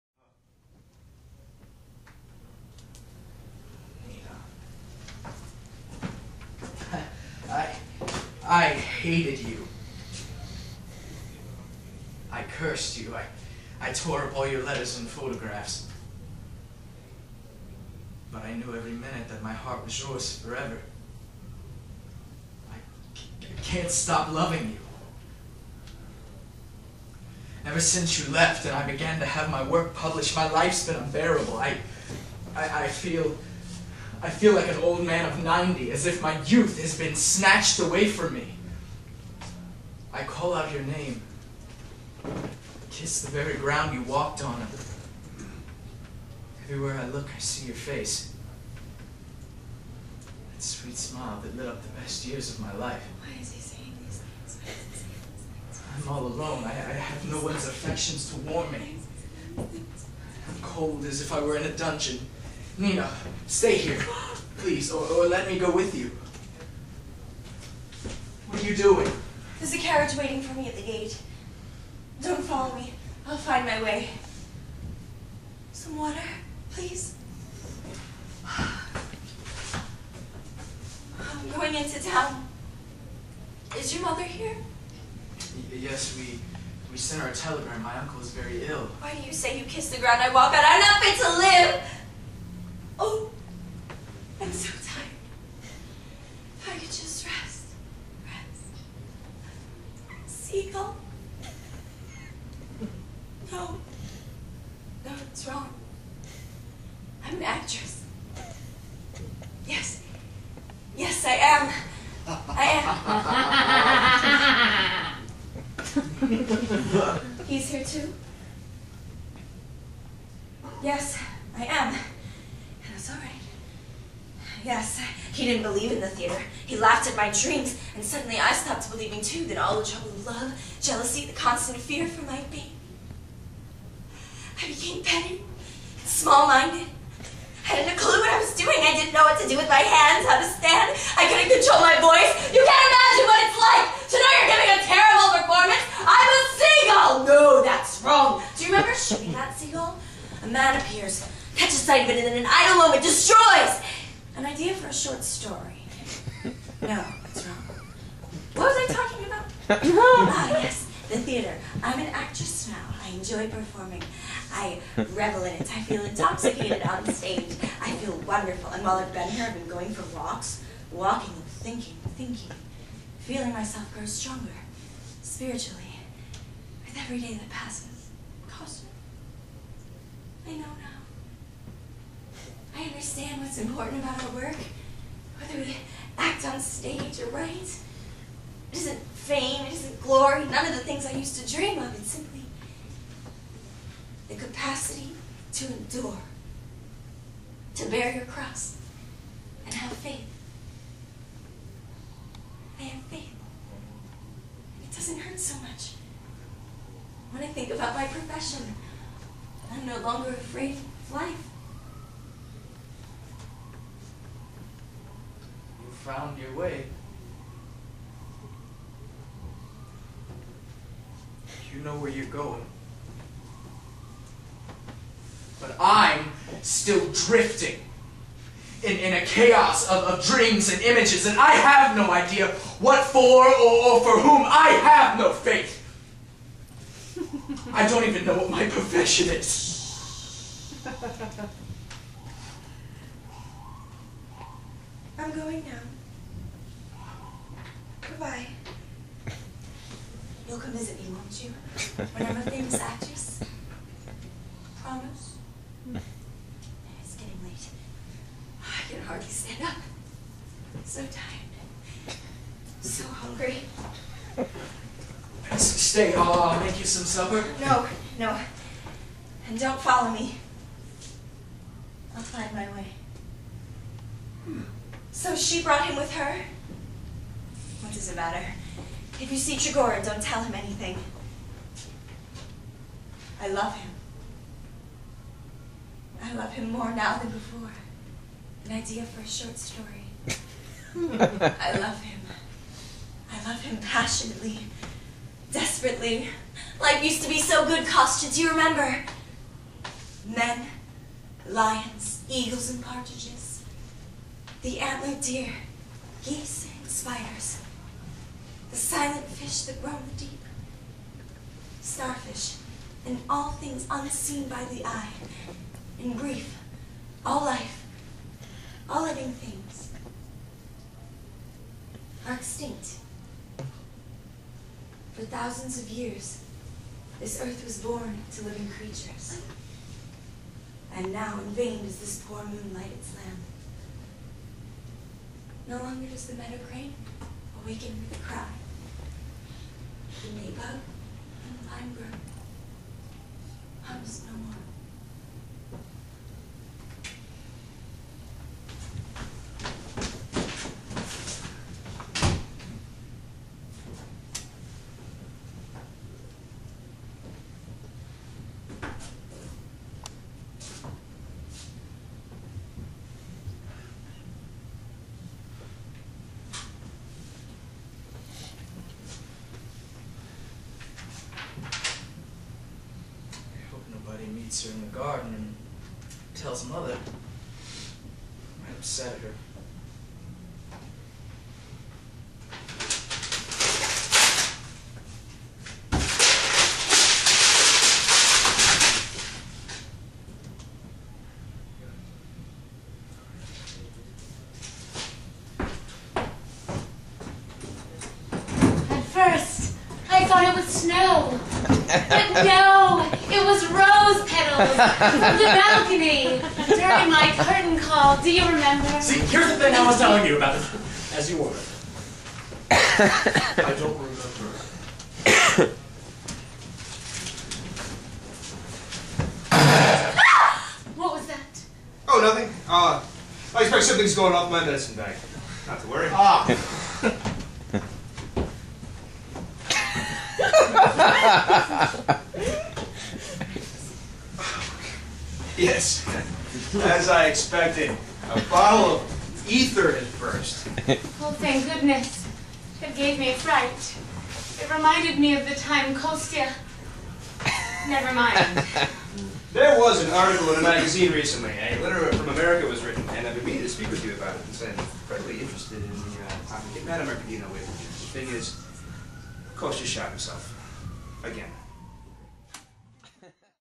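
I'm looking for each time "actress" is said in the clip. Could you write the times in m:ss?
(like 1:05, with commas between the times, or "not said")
1:47, 2:42, 4:12.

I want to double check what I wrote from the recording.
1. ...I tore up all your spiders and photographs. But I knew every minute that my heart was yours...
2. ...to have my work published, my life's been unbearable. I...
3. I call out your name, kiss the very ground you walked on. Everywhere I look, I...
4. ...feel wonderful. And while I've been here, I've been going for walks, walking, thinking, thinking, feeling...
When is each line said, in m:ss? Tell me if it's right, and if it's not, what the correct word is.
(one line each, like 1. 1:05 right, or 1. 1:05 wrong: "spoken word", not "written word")
1. 0:13 wrong: "letters", not "spiders"
2. 0:29 right
3. 0:40 right
4. 2:48 right.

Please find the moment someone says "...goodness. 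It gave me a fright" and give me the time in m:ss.
7:21.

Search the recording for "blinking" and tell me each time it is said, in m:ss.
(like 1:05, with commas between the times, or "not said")
not said.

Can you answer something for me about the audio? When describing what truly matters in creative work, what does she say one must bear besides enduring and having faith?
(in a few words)
Your cross.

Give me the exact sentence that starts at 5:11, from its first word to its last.
Starfish, and all things unseen by the eye.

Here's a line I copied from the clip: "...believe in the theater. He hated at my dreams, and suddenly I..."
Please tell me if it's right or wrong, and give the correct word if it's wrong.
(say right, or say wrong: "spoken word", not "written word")
wrong: "laughed", not "hated".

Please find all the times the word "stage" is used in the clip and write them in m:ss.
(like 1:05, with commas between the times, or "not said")
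2:47, 3:06.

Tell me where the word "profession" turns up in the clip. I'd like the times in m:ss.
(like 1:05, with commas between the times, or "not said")
3:28, 3:58.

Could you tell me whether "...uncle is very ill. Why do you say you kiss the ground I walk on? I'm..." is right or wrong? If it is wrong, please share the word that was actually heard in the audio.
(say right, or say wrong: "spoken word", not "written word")
right.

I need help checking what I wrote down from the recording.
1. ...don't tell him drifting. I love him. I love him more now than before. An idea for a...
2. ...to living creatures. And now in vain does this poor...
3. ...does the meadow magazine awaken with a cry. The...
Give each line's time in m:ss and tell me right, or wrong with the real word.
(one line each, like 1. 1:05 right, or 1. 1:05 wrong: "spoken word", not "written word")
1. 4:40 wrong: "anything", not "drifting"
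2. 5:28 right
3. 5:36 wrong: "crane", not "magazine".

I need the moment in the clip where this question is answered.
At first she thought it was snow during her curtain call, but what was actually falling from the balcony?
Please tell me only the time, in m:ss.
6:43.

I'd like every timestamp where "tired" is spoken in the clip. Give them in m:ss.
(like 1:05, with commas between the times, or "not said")
1:34, 4:21.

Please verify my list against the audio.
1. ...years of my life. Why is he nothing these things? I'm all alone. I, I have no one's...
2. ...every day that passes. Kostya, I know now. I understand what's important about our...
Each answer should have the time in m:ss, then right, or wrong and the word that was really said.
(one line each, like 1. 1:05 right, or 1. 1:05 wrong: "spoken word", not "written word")
1. 0:52 wrong: "saying", not "nothing"
2. 2:56 right.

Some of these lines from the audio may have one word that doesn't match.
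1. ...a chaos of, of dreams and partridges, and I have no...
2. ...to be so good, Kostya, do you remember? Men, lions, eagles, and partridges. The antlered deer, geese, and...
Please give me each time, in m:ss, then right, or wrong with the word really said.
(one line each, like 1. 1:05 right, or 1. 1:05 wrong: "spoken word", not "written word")
1. 3:49 wrong: "images", not "partridges"
2. 4:57 right.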